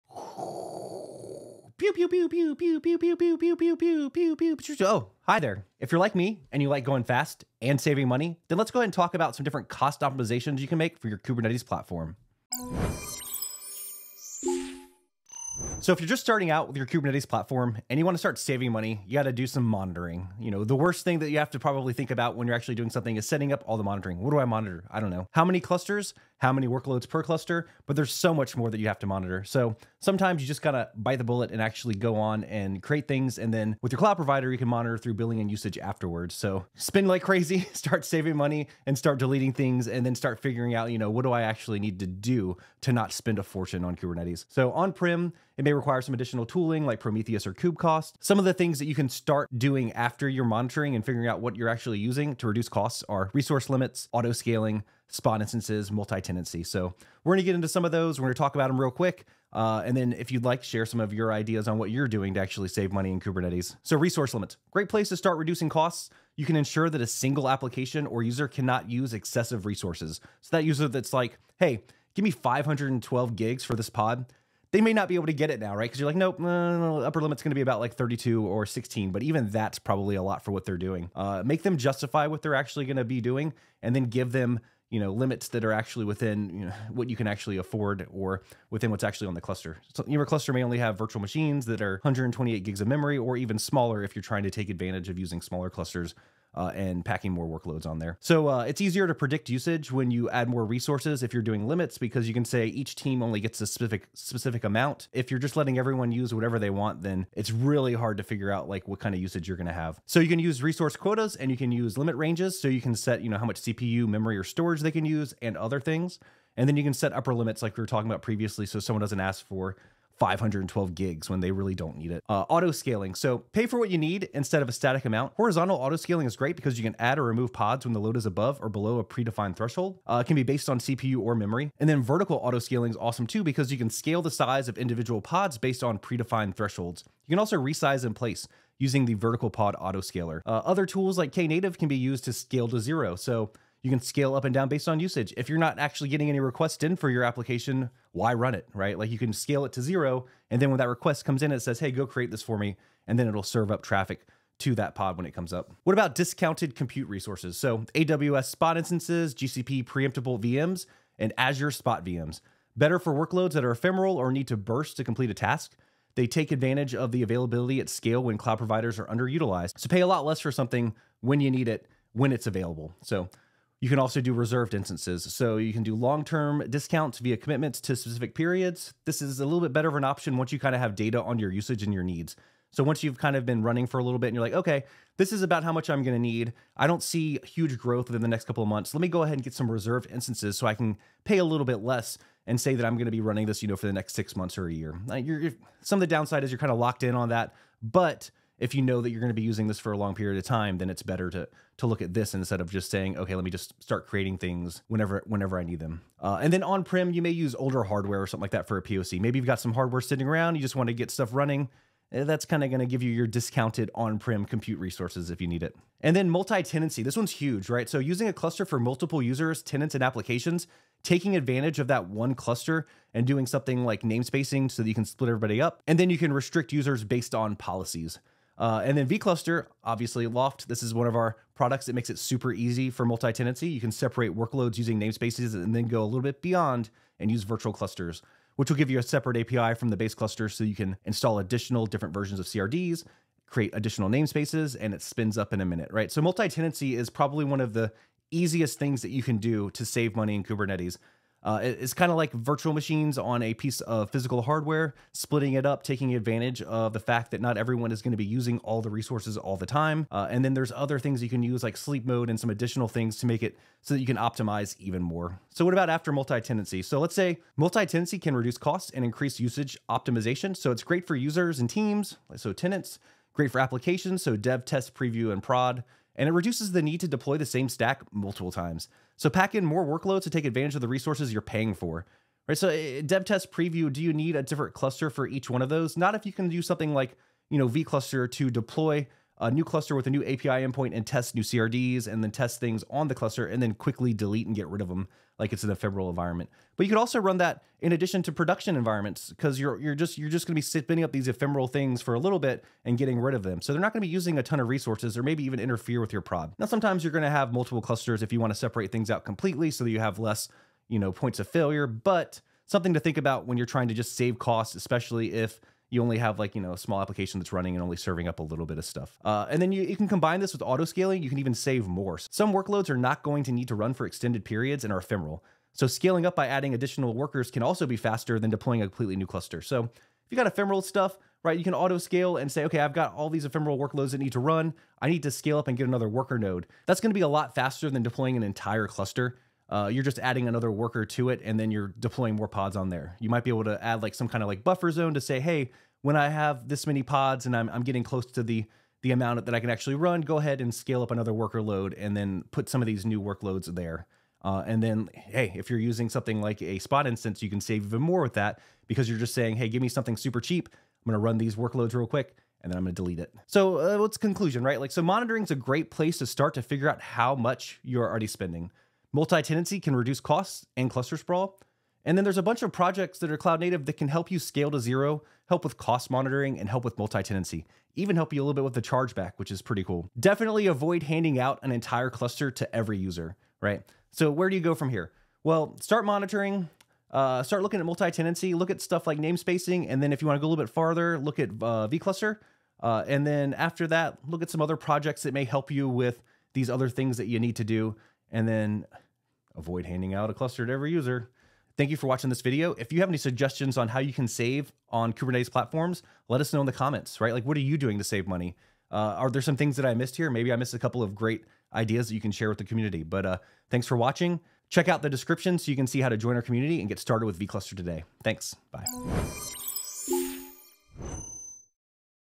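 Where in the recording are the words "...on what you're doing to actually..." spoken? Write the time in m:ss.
1:01.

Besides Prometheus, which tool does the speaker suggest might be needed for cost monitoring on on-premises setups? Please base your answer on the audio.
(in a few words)
KubeCost.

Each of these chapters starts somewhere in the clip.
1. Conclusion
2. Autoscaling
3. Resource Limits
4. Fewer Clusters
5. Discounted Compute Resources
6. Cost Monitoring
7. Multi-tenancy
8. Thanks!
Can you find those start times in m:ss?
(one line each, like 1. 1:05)
1. 6:03
2. 2:02
3. 1:04
4. 4:25
5. 2:35
6. 0:15
7. 3:35
8. 6:41.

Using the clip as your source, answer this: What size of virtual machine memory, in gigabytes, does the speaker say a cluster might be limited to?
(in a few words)
128 gigs.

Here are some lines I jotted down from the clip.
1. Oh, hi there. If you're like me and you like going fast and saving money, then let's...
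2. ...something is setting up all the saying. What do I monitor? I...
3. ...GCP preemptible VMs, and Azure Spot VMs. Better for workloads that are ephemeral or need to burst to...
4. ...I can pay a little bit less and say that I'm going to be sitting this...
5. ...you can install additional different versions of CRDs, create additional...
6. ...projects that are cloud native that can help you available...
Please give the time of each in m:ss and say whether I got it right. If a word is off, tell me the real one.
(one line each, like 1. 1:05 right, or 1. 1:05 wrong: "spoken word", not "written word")
1. 0:04 right
2. 0:22 wrong: "monitoring", not "saying"
3. 2:39 right
4. 3:10 wrong: "running", not "sitting"
5. 4:00 right
6. 6:12 wrong: "scale", not "available".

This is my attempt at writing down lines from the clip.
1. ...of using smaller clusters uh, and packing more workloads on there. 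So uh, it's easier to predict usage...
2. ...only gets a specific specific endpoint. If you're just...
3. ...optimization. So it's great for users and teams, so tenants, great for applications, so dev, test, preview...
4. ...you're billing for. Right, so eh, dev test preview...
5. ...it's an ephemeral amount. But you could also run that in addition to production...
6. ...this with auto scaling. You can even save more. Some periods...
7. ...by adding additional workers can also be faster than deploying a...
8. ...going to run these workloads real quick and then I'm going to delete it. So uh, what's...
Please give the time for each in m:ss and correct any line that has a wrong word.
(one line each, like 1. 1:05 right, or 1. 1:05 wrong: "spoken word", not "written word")
1. 1:35 right
2. 1:43 wrong: "amount", not "endpoint"
3. 4:29 right
4. 4:41 wrong: "paying", not "billing"
5. 4:55 wrong: "environment", not "amount"
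6. 5:20 wrong: "workloads", not "periods"
7. 5:26 right
8. 6:01 right.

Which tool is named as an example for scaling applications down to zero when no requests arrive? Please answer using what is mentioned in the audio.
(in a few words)
Knative.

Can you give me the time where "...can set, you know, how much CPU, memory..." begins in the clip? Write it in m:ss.
1:52.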